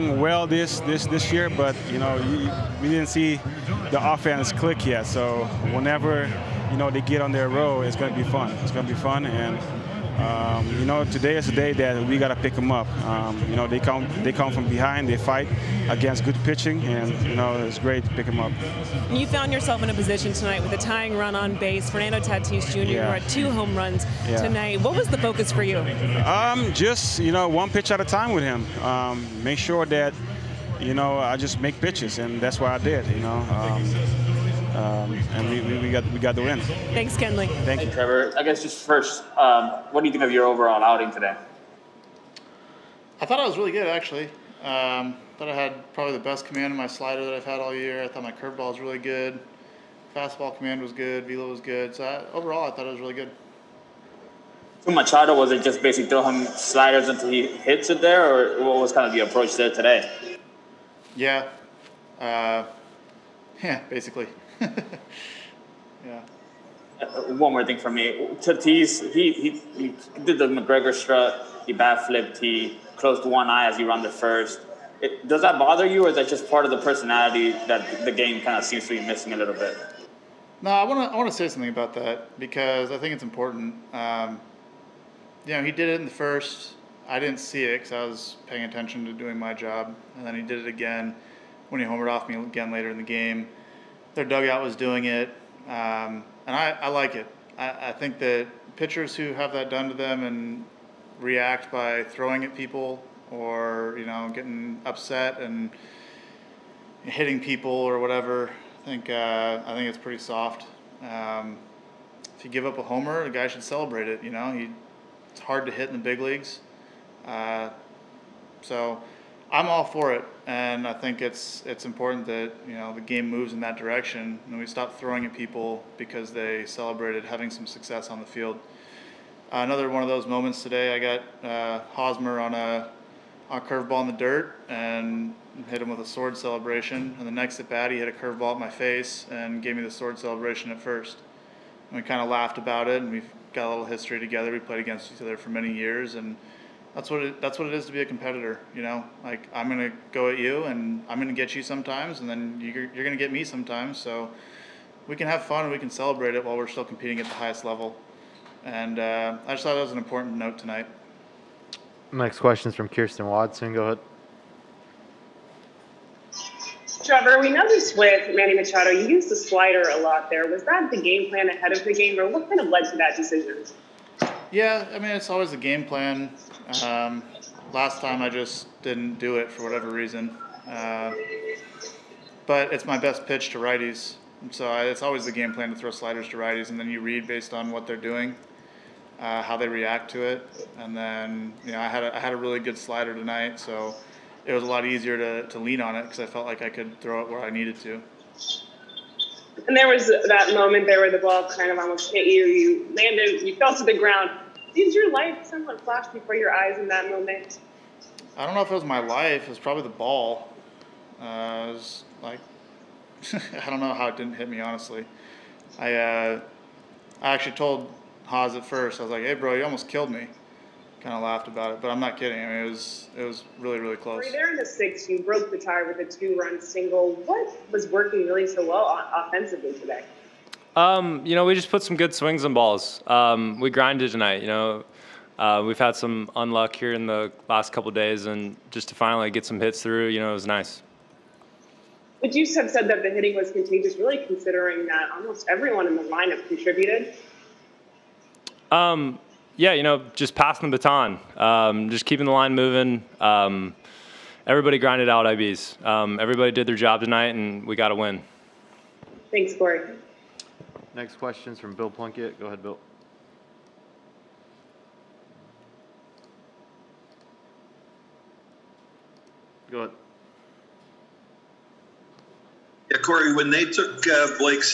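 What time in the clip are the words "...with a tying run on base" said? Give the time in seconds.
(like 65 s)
20 s.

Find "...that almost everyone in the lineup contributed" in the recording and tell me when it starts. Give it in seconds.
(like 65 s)
244 s.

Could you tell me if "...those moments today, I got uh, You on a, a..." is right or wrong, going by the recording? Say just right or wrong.
wrong.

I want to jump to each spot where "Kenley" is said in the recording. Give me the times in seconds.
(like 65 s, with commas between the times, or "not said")
37 s.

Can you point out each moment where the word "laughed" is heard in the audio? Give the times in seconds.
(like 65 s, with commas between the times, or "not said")
142 s, 221 s.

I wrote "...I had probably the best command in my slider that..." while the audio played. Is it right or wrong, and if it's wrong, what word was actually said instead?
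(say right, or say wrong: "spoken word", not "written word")
right.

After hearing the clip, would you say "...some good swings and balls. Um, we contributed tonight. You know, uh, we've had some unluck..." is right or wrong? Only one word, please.
wrong.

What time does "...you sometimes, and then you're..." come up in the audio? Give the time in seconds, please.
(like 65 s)
151 s.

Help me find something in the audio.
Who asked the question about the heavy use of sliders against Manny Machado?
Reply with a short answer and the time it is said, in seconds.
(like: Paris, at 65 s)
Kirsten Watson, at 162 s.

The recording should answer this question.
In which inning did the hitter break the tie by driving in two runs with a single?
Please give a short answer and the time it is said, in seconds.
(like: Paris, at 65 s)
sixth, at 224 s.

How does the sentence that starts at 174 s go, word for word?
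Yeah, I mean, it's always a game plan.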